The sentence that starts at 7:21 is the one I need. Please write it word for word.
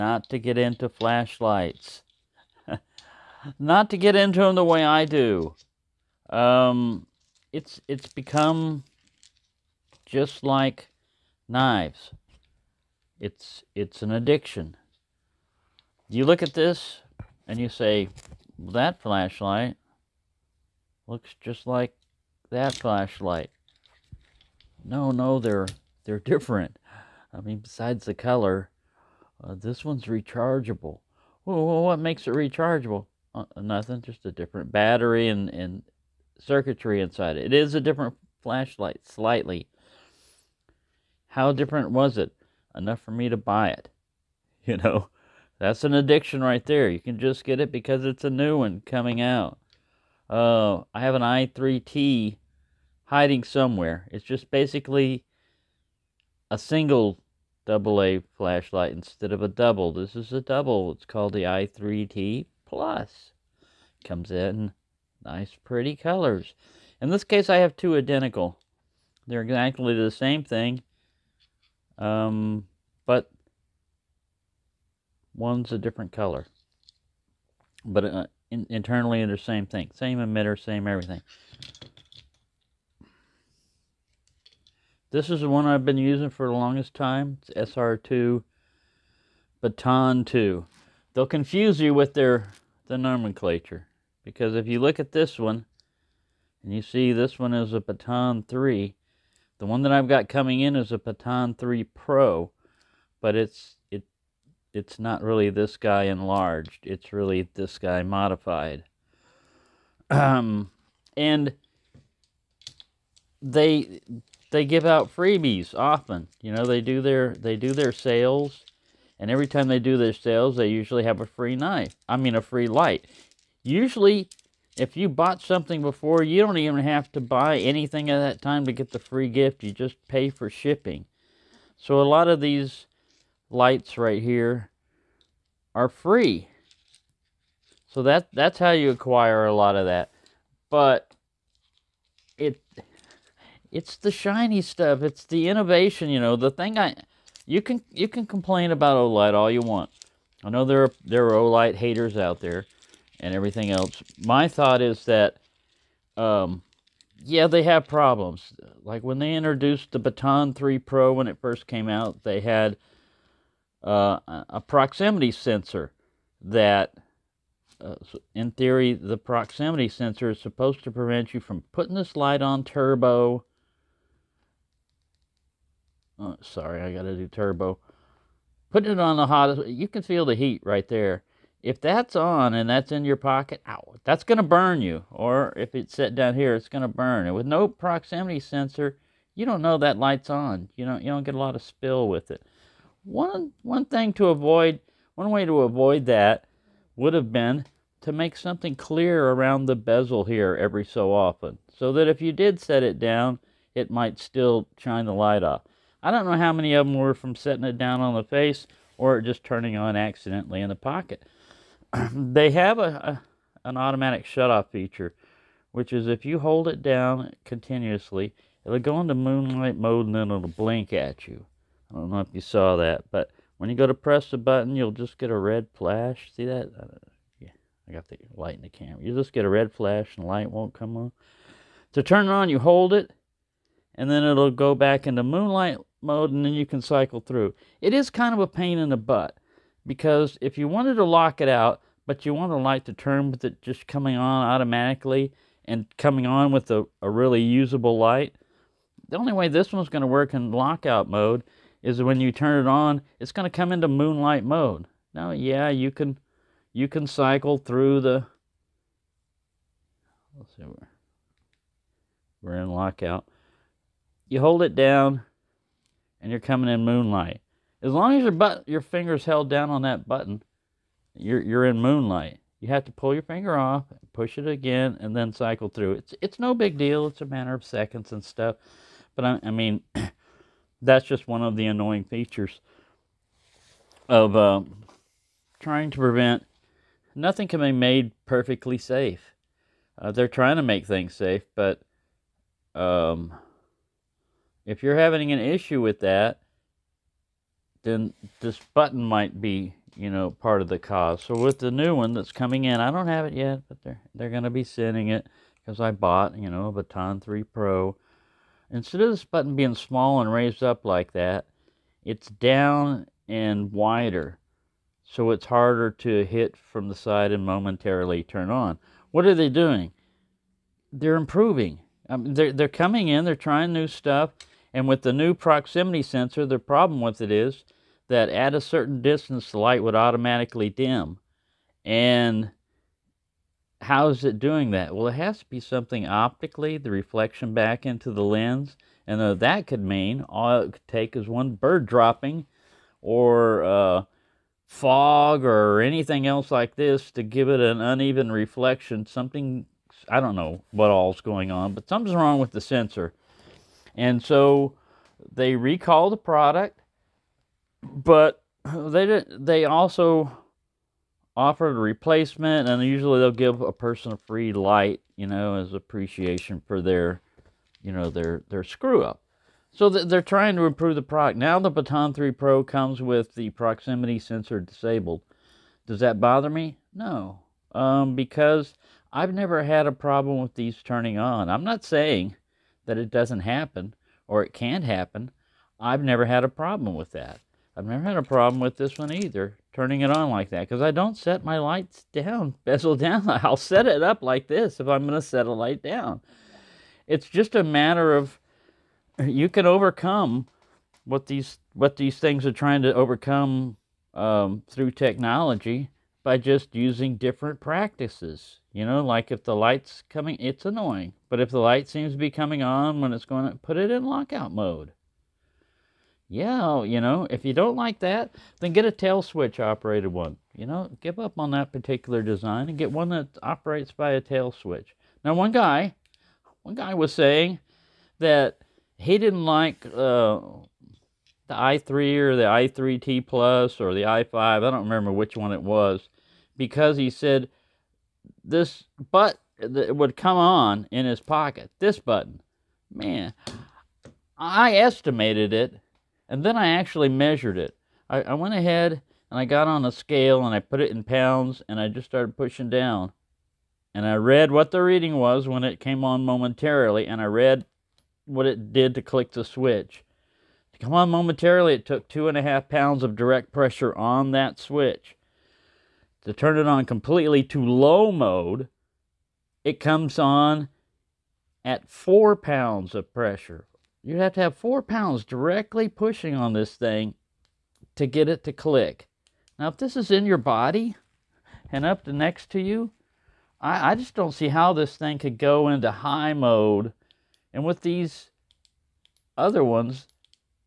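This button, man, I estimated it and then I actually measured it.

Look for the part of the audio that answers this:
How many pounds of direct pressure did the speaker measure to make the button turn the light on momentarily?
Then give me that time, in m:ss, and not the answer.
7:42.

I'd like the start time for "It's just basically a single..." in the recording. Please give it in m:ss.
0:54.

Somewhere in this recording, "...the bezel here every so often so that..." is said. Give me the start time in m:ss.
3:19.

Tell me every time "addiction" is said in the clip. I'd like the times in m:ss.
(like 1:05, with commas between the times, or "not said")
0:14, 0:45.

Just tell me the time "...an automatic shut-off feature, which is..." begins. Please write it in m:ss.
3:33.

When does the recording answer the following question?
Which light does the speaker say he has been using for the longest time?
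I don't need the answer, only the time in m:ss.
1:27.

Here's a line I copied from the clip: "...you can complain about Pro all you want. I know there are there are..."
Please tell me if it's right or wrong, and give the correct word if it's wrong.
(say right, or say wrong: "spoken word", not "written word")
wrong: "Olight", not "Pro".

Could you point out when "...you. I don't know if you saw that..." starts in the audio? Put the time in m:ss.
3:41.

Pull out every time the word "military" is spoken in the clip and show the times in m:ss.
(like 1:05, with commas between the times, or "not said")
not said.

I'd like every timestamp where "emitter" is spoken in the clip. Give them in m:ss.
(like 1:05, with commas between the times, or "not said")
1:20.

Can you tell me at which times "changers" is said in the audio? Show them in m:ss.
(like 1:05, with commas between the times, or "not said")
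not said.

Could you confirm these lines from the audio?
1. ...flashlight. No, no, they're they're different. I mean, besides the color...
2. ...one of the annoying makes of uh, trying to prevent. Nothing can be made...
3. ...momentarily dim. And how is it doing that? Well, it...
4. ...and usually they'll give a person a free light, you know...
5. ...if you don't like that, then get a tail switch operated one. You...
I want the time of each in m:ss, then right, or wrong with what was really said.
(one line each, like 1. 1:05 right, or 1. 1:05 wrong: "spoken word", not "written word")
1. 0:22 right
2. 4:41 wrong: "features", not "makes"
3. 5:29 wrong: "automatically", not "momentarily"
4. 6:02 right
5. 6:57 right.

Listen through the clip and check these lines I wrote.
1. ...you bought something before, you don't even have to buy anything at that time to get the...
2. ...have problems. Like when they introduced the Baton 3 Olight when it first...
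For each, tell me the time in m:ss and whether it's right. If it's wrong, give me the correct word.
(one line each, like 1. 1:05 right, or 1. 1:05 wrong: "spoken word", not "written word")
1. 2:04 right
2. 2:37 wrong: "Pro", not "Olight".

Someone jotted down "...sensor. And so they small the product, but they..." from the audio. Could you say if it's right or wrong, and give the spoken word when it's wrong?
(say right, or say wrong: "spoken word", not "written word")
wrong: "recall", not "small".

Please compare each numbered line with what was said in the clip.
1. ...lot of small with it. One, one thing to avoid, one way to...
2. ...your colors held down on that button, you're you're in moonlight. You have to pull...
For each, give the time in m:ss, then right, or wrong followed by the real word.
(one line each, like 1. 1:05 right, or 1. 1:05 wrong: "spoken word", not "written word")
1. 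3:11 wrong: "spill", not "small"
2. 4:28 wrong: "fingers", not "colors".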